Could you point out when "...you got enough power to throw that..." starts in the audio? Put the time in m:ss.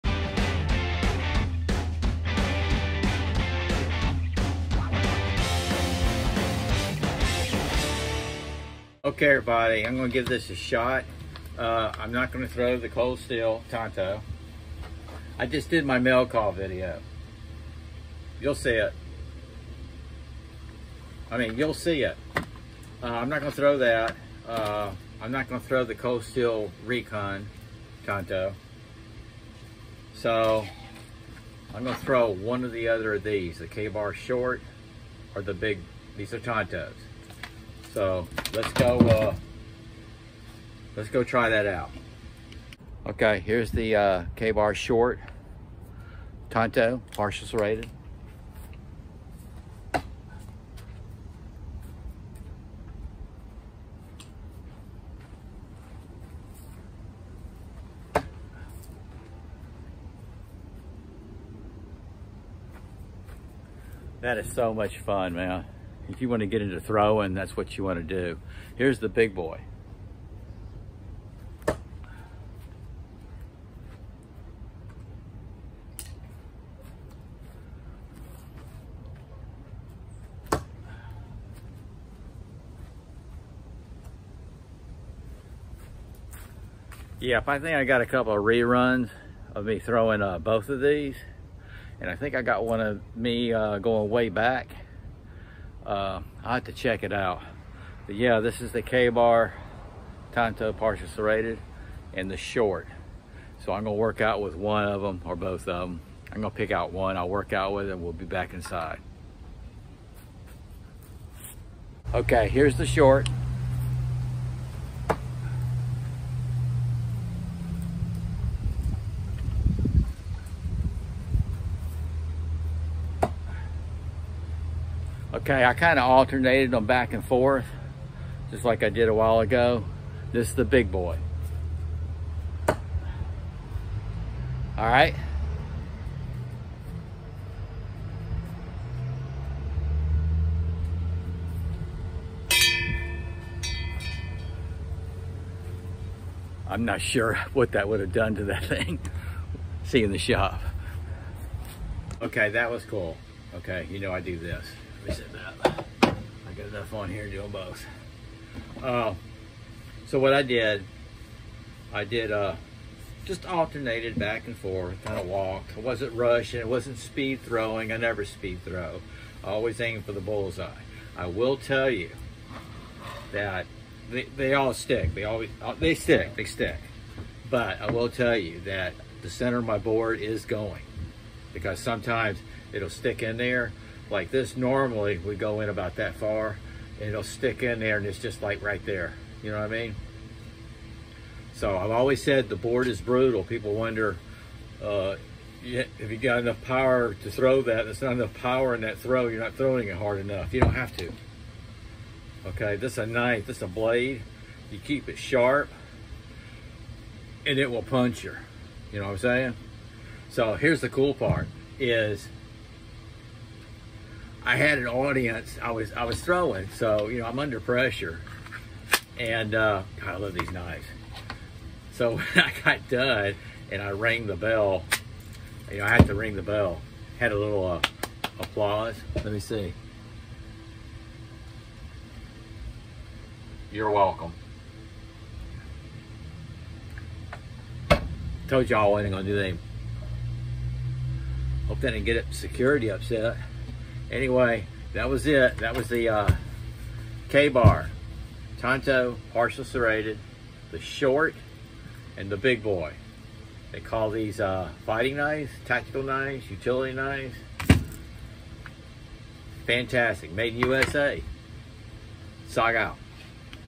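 3:16.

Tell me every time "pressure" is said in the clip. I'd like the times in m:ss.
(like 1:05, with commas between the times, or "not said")
3:37.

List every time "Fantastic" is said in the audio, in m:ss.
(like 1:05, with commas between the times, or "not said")
4:19.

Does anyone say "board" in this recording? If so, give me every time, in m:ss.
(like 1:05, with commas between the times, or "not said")
2:59, 3:12.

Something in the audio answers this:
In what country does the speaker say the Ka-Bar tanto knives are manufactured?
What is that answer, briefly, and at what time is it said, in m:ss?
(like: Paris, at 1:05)
USA, at 4:20.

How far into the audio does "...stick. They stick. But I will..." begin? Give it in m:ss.
2:55.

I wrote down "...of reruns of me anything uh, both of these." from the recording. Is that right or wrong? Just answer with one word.
wrong.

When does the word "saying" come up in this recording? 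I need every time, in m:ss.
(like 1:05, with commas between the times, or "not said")
3:29.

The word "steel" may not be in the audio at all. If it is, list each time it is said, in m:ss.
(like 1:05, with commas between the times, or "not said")
0:13, 0:26.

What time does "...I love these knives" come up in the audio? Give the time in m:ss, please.
3:40.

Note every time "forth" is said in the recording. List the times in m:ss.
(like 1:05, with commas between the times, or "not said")
2:07, 2:44.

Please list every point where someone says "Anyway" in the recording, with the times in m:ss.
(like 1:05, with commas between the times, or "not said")
4:04.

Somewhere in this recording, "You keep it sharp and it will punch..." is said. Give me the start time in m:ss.
3:24.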